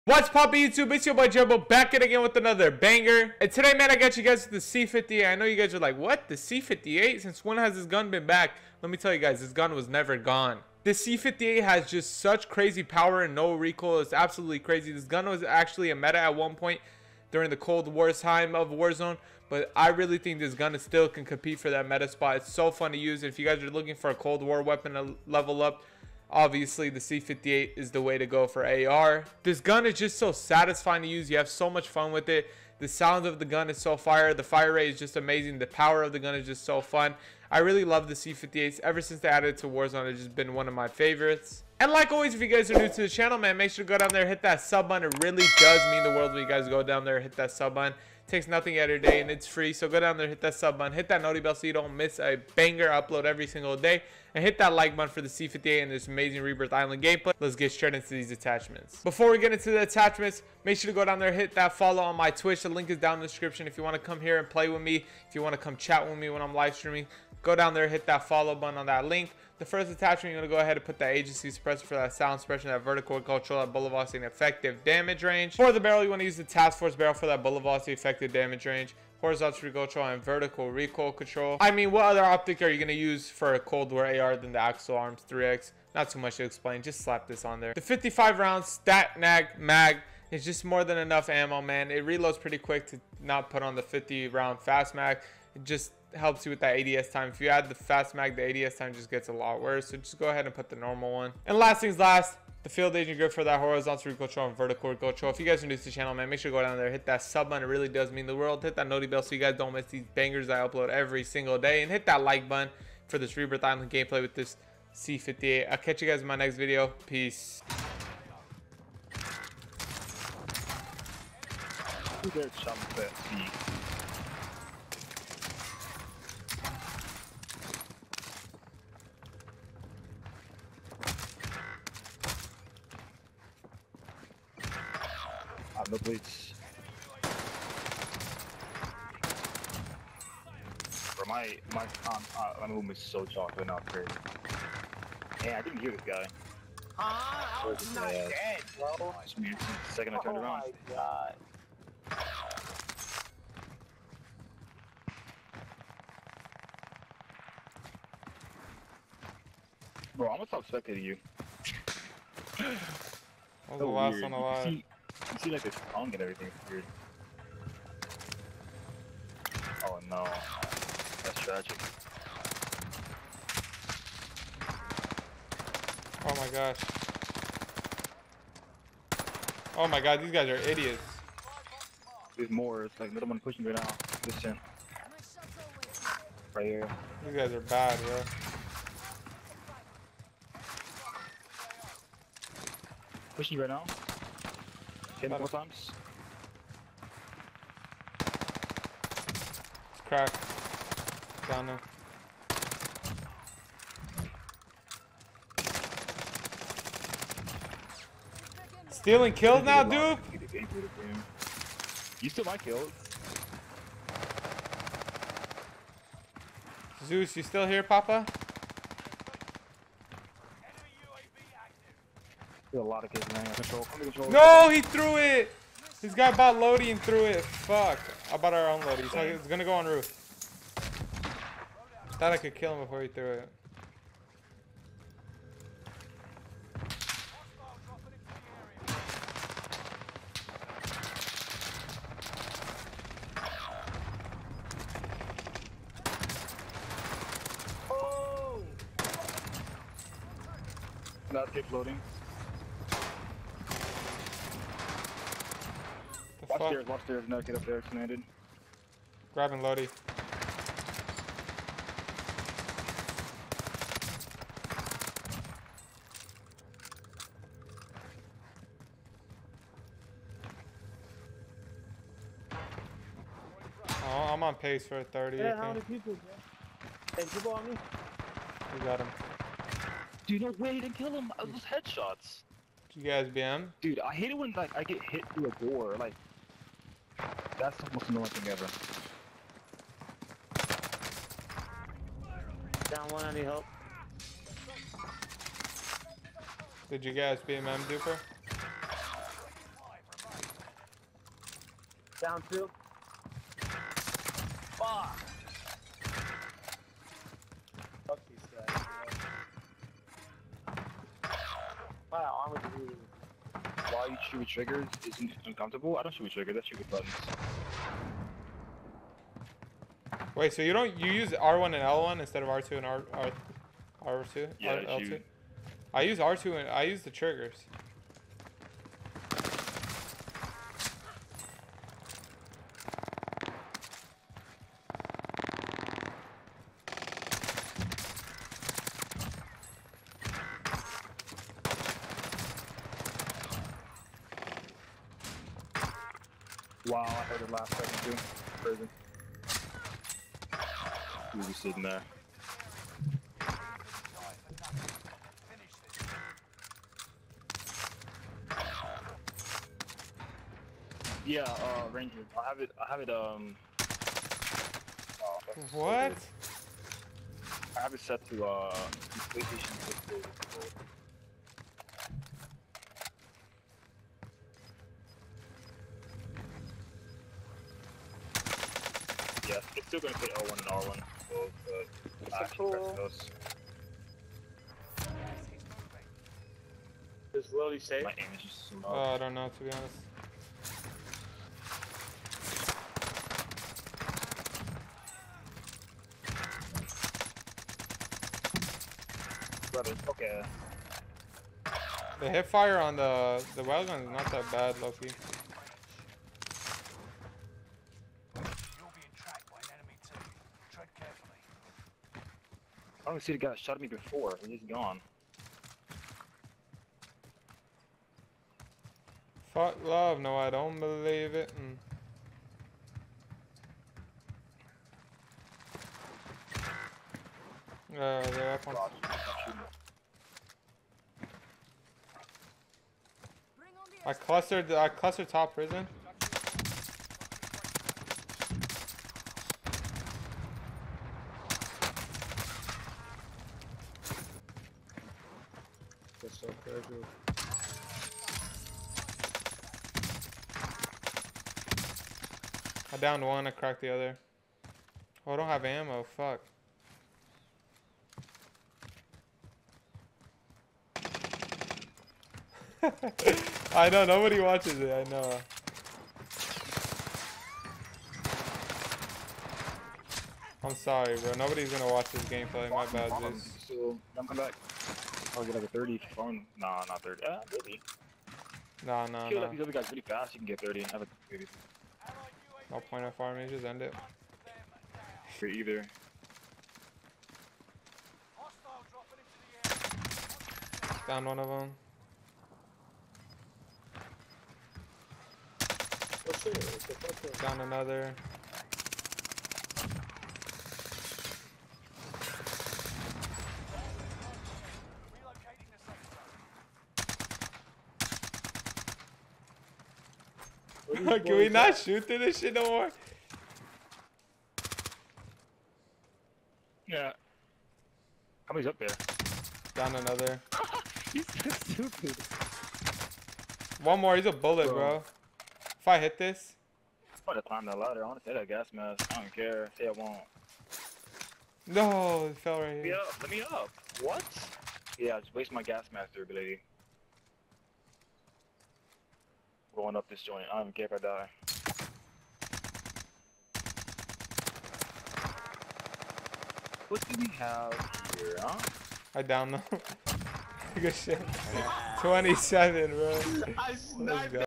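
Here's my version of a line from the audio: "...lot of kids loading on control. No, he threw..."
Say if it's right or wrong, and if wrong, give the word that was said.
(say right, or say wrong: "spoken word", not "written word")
wrong: "running", not "loading".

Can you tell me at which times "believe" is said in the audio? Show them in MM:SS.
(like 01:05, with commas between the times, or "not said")
07:00.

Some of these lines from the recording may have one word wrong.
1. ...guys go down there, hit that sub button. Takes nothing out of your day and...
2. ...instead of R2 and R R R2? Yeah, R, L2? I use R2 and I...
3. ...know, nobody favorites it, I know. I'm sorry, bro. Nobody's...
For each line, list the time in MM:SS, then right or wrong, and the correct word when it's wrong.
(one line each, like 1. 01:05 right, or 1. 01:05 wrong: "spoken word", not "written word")
1. 00:46 right
2. 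05:22 right
3. 07:43 wrong: "watches", not "favorites".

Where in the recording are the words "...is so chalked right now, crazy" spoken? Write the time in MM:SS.
02:22.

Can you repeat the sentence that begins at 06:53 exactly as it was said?
I don't see the guy that shot at me before.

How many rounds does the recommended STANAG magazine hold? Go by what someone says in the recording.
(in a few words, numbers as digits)
55.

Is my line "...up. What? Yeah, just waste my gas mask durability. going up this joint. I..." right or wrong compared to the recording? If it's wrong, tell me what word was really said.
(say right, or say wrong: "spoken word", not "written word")
right.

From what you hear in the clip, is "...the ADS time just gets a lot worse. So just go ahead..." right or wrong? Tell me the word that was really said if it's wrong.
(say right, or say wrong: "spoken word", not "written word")
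right.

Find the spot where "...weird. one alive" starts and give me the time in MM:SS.
02:44.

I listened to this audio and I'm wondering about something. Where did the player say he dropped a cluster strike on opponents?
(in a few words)
Top prison.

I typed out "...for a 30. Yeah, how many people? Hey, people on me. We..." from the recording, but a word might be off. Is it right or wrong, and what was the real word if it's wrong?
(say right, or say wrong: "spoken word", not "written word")
right.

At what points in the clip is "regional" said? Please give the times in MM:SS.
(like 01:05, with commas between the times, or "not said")
not said.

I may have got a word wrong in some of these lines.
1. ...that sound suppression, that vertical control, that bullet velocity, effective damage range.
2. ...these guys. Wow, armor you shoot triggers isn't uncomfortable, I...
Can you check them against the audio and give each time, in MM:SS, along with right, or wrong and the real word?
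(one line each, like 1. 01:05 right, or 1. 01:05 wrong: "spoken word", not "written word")
1. 01:11 right
2. 05:08 right.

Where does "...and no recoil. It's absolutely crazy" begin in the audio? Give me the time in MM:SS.
00:13.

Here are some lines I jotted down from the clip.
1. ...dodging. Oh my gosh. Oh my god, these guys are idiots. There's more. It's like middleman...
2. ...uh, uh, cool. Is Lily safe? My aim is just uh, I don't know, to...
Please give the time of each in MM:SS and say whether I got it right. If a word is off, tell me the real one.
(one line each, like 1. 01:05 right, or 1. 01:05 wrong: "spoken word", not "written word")
1. 02:51 right
2. 06:22 right.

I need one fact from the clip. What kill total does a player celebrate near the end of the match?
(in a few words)
27.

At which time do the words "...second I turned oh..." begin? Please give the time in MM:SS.
02:29.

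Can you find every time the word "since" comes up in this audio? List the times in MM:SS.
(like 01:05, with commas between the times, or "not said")
00:07, 00:39.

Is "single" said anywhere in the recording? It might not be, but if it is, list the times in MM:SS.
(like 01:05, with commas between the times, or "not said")
00:53, 01:51.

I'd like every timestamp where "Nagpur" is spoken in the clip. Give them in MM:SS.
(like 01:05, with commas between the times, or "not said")
not said.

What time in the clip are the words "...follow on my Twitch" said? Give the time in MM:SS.
01:01.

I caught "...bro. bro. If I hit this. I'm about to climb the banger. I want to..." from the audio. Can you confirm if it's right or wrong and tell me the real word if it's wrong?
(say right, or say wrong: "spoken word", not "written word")
wrong: "ladder", not "banger".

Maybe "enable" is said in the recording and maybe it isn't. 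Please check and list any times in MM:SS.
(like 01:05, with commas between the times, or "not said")
not said.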